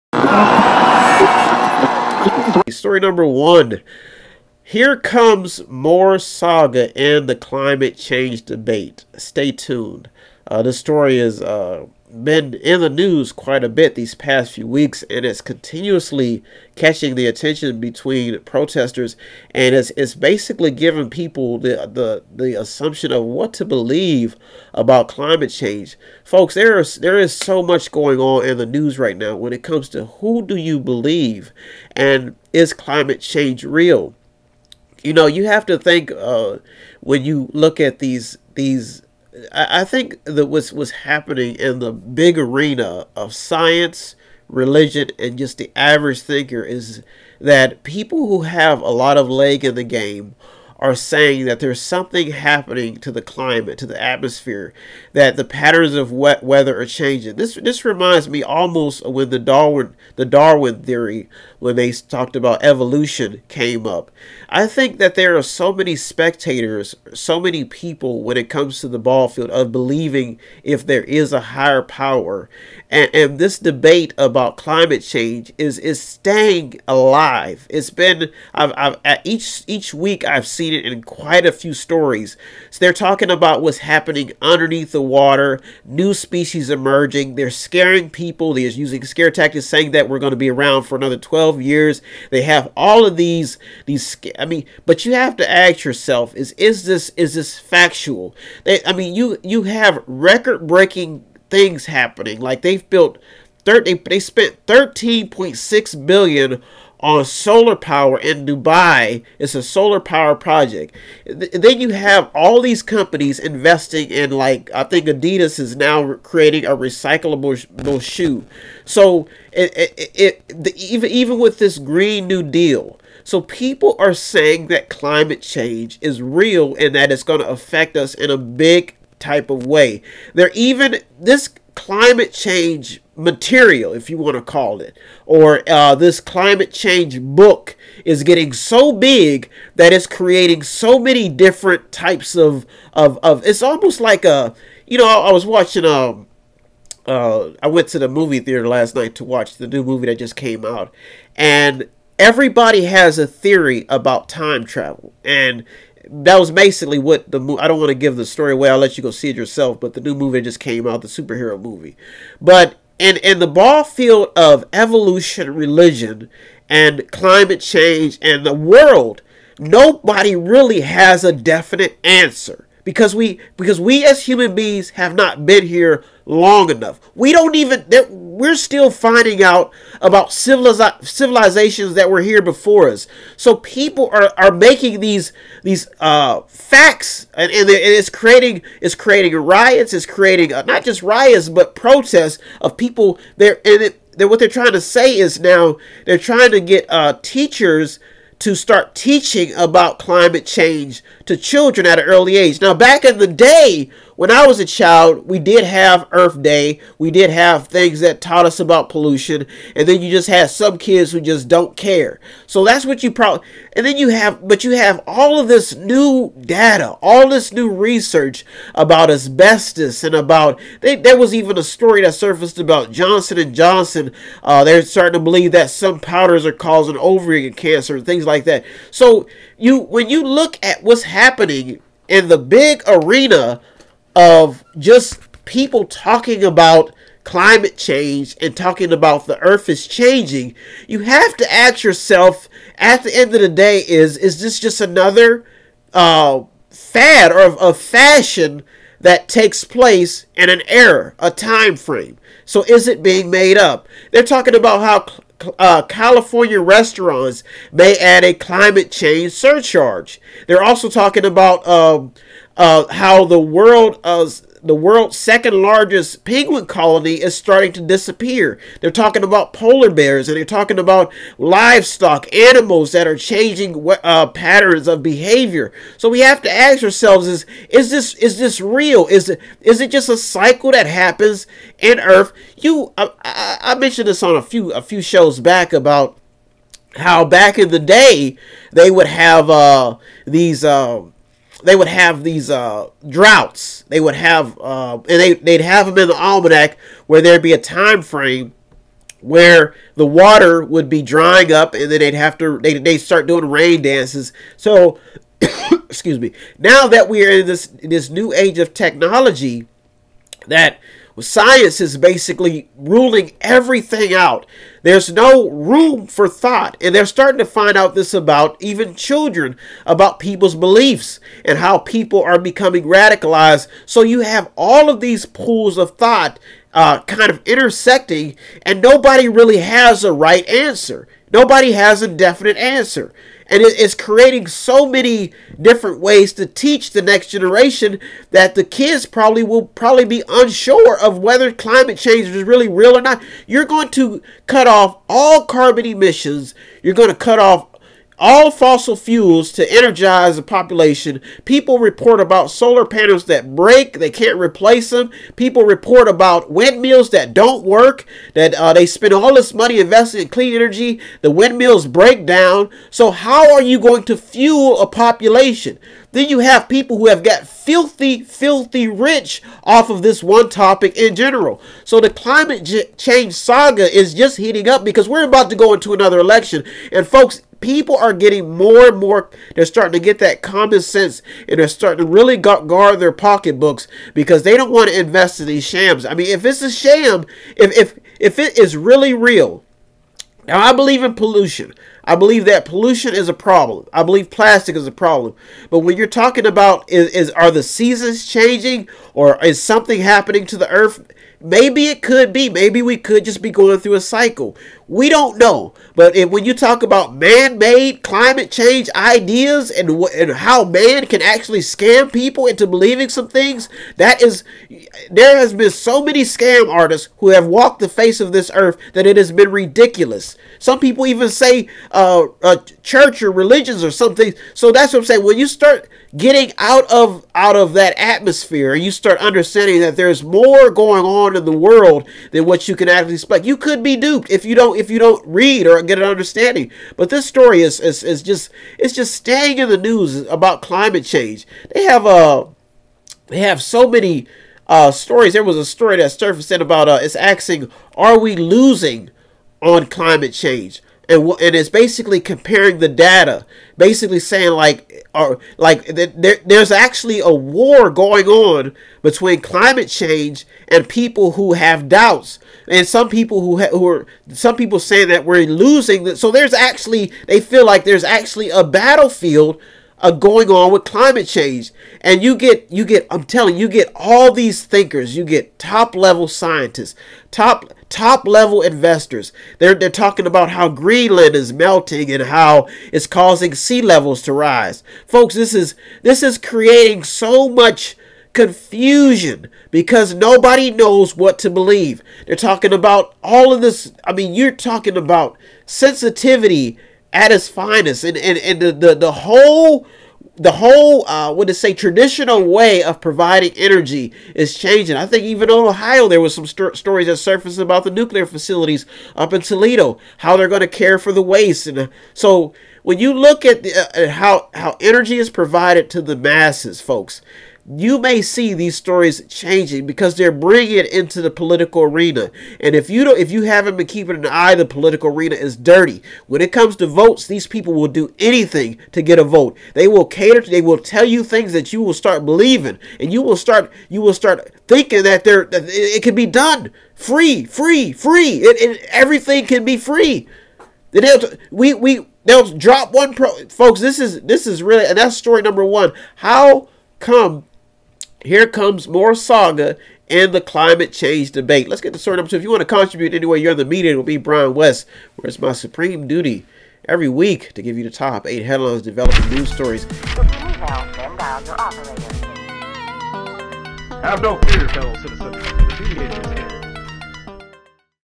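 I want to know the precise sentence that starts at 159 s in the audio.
But the new movie just came out, the superhero movie.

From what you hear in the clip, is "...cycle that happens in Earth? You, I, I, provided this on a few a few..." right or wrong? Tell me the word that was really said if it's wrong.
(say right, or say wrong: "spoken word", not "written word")
wrong: "mentioned", not "provided".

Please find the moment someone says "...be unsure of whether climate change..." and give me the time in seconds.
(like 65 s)
340 s.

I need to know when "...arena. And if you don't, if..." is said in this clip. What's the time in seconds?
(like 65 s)
521 s.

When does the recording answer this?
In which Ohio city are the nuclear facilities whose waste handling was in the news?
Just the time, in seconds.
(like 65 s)
509 s.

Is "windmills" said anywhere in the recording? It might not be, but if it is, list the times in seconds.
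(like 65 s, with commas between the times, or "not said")
356 s, 361 s.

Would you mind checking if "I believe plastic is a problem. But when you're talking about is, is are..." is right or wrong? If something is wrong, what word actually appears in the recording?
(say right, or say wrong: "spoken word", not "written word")
right.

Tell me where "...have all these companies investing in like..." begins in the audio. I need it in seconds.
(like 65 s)
111 s.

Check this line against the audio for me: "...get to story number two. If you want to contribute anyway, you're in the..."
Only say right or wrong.
right.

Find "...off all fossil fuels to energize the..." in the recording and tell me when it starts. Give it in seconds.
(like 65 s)
347 s.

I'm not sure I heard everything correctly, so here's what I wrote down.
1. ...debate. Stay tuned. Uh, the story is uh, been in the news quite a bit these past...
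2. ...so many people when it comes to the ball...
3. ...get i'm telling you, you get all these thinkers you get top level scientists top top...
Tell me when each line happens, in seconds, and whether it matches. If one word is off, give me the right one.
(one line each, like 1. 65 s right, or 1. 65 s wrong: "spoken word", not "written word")
1. 8 s right
2. 67 s right
3. 472 s right.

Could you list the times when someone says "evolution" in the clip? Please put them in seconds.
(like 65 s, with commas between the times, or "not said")
62 s, 164 s.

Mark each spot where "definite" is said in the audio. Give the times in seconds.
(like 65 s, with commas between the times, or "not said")
171 s, 332 s.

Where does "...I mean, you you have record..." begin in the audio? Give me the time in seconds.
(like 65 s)
98 s.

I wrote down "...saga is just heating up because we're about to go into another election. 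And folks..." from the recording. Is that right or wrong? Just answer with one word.
right.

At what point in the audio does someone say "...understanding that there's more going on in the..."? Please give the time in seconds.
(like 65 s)
429 s.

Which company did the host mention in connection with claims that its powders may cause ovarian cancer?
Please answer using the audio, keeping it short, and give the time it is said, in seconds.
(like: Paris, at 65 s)
Johnson and Johnson, at 222 s.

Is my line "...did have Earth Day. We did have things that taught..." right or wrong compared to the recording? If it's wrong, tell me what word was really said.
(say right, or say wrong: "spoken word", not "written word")
right.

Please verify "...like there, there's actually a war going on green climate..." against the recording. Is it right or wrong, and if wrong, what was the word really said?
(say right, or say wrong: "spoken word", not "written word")
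wrong: "between", not "green".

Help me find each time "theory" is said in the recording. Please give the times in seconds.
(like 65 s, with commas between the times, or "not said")
60 s, 153 s.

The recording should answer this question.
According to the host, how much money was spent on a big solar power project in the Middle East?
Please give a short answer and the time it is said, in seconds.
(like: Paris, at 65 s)
13.6 billion, at 104 s.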